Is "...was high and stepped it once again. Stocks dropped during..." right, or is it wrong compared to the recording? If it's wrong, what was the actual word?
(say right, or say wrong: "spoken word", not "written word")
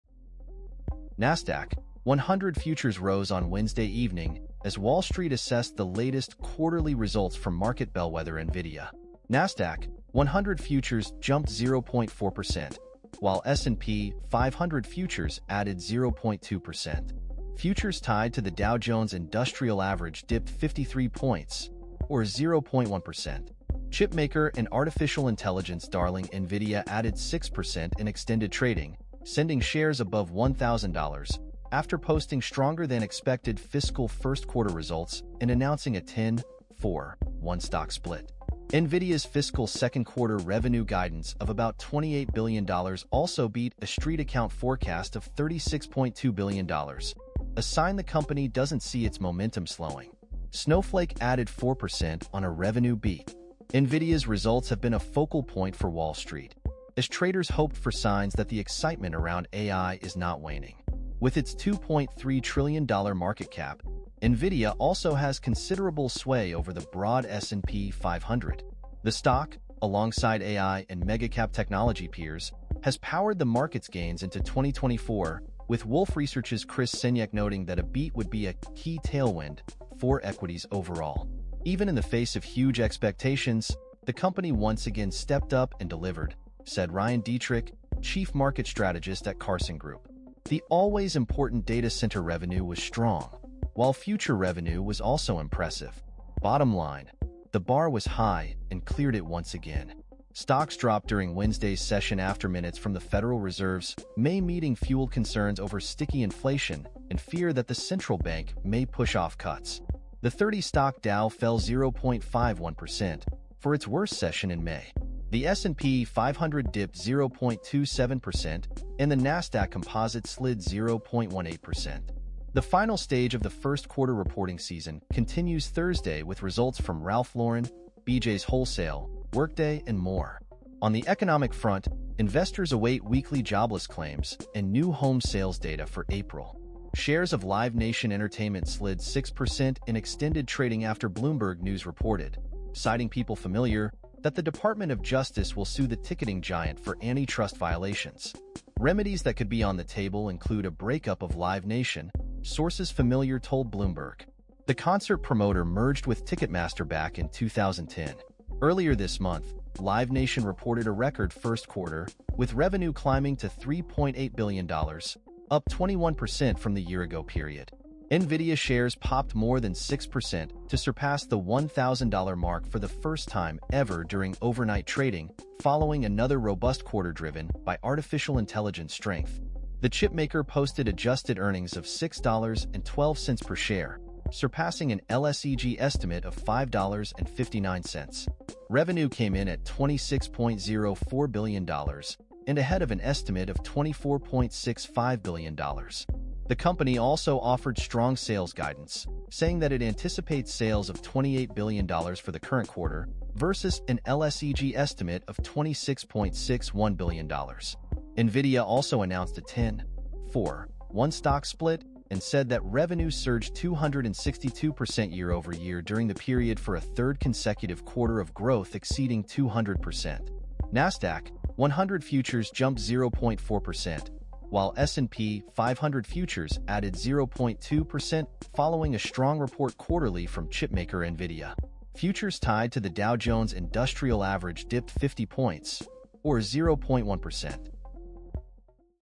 wrong: "cleared", not "stepped".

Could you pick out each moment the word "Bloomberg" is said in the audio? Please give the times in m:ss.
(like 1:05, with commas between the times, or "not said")
2:21, 2:33.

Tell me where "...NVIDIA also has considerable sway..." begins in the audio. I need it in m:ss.
1:04.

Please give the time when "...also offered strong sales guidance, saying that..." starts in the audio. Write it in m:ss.
3:16.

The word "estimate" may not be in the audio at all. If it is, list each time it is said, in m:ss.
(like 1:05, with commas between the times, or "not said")
3:05, 3:12, 3:24.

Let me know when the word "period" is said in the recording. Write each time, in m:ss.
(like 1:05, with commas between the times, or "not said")
2:47, 3:36.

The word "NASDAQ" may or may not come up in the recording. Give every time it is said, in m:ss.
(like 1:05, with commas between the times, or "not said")
0:01, 0:09, 1:59, 3:40.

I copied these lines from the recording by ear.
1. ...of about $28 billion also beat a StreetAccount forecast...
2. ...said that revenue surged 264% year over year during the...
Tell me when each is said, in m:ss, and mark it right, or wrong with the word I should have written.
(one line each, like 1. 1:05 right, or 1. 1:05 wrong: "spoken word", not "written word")
1. 0:41 right
2. 3:32 wrong: "262", not "264".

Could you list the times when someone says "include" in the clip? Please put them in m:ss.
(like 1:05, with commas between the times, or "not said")
2:30.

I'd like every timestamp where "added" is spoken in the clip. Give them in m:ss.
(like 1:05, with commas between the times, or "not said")
0:15, 0:26, 0:51, 3:46.